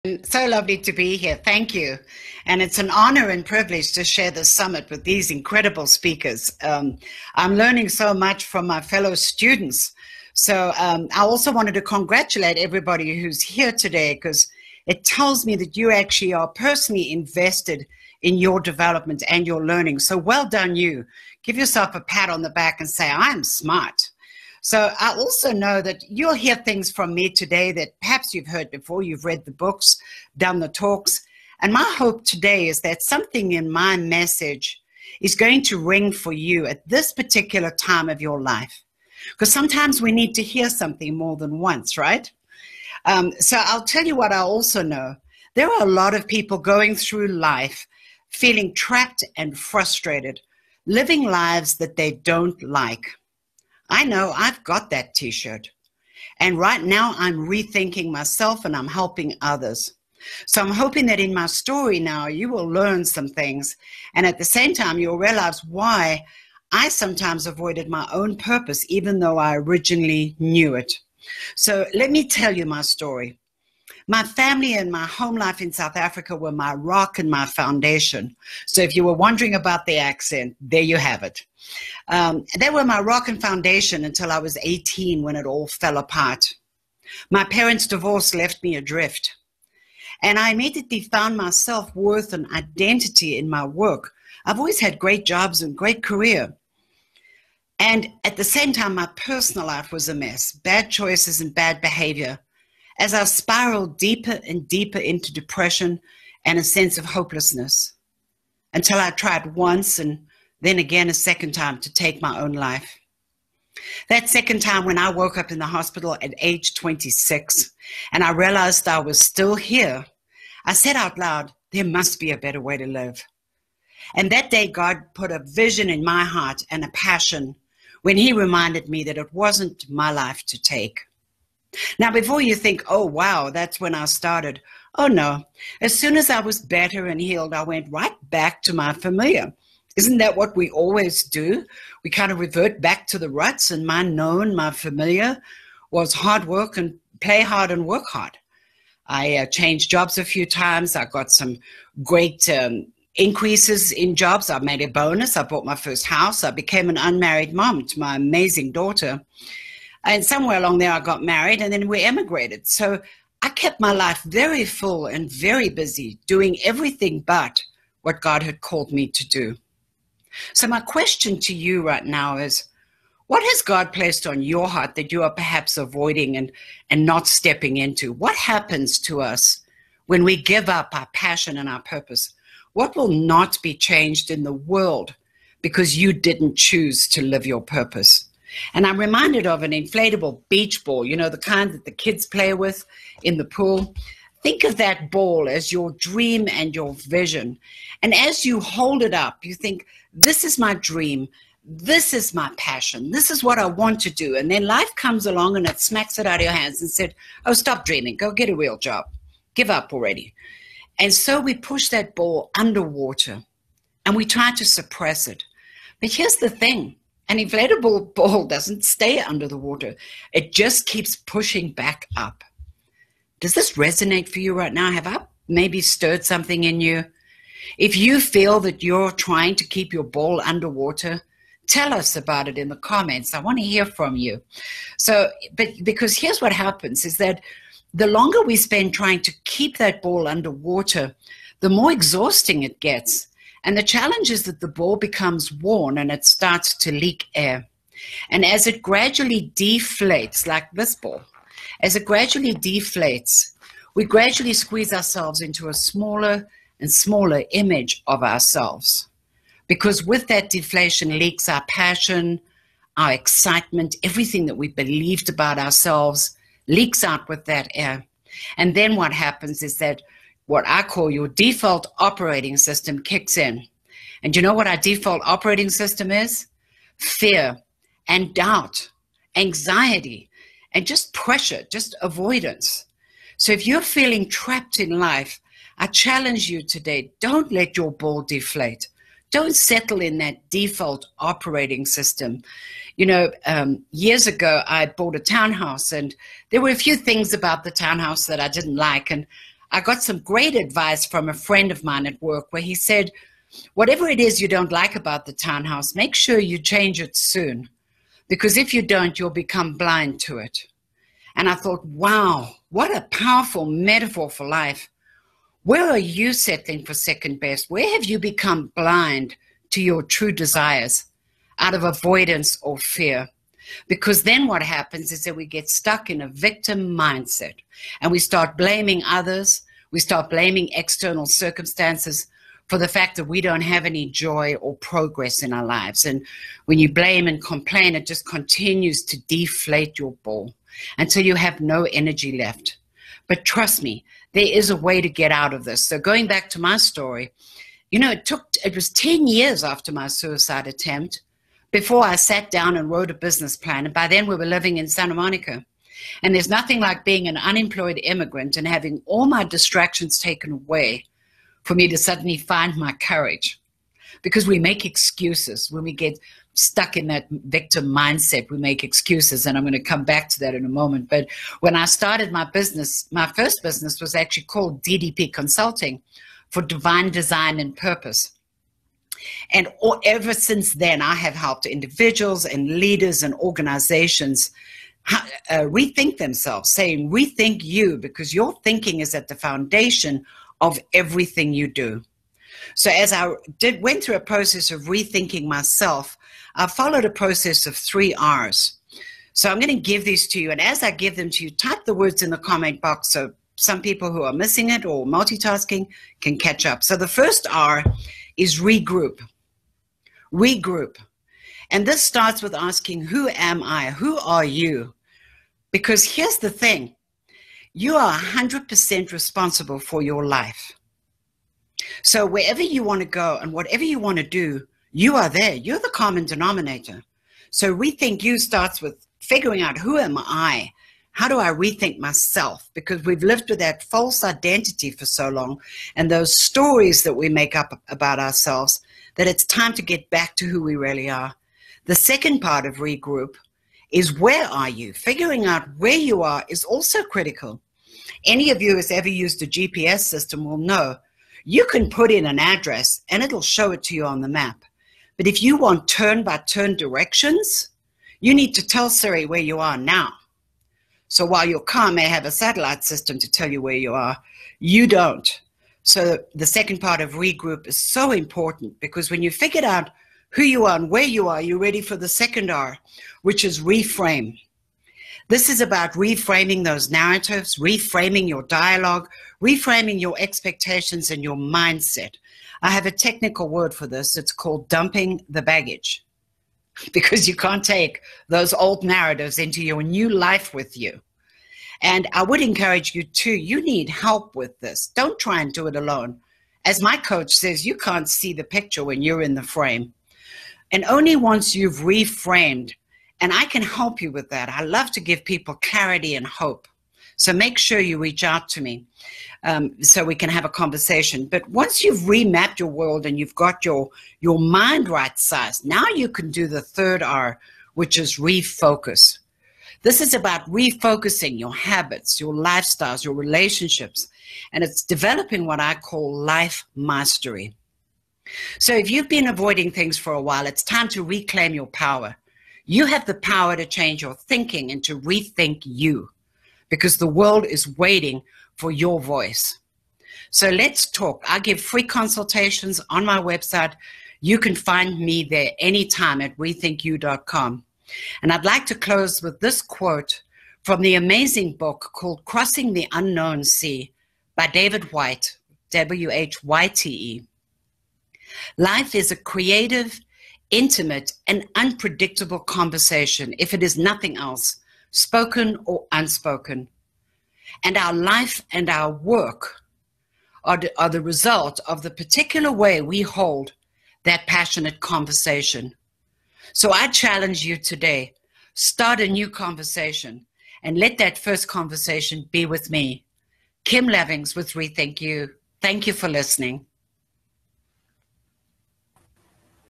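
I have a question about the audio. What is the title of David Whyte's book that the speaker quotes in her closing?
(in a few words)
Crossing the Unknown Sea.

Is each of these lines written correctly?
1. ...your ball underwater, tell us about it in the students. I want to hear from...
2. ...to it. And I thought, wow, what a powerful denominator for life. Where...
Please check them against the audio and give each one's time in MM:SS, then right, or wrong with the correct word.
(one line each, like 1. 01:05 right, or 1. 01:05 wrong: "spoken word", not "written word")
1. 03:49 wrong: "comments", not "students"
2. 05:10 wrong: "metaphor", not "denominator".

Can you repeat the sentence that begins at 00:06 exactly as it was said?
Um, I'm learning so much from my fellow students.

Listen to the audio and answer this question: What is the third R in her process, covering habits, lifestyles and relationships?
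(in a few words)
Refocus.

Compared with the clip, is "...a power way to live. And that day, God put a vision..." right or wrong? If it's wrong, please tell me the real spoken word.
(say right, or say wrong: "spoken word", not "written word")
wrong: "better", not "power".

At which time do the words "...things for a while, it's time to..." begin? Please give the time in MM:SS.
08:49.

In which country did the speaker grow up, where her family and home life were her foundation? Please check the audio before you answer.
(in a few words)
South Africa.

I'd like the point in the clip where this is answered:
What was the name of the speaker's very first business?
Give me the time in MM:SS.
06:14.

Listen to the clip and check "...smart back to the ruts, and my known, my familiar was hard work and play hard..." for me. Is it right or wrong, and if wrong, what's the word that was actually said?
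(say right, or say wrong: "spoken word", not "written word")
wrong: "revert", not "smart".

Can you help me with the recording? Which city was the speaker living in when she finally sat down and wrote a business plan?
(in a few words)
Santa Monica.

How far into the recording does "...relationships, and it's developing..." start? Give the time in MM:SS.
08:43.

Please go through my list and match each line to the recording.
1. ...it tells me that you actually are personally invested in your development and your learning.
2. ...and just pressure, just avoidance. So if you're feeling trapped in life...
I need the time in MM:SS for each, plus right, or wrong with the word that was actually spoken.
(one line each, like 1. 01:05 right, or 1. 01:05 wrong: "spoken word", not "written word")
1. 00:14 right
2. 04:40 right.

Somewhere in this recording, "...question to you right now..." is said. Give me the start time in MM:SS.
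02:50.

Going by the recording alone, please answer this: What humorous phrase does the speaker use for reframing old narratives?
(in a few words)
Dumping the baggage.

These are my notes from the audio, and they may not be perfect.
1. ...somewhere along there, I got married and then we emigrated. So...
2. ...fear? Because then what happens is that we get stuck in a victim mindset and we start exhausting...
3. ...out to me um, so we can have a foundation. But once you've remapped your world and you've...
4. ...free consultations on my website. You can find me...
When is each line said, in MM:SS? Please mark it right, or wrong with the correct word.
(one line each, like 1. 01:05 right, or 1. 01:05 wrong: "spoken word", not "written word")
1. 02:40 right
2. 05:22 wrong: "blaming", not "exhausting"
3. 08:28 wrong: "conversation", not "foundation"
4. 09:01 right.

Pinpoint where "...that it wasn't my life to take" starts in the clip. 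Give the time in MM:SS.
02:09.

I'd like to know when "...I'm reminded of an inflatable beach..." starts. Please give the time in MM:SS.
03:08.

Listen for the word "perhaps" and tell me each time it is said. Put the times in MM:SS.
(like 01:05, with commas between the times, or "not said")
00:27, 02:55.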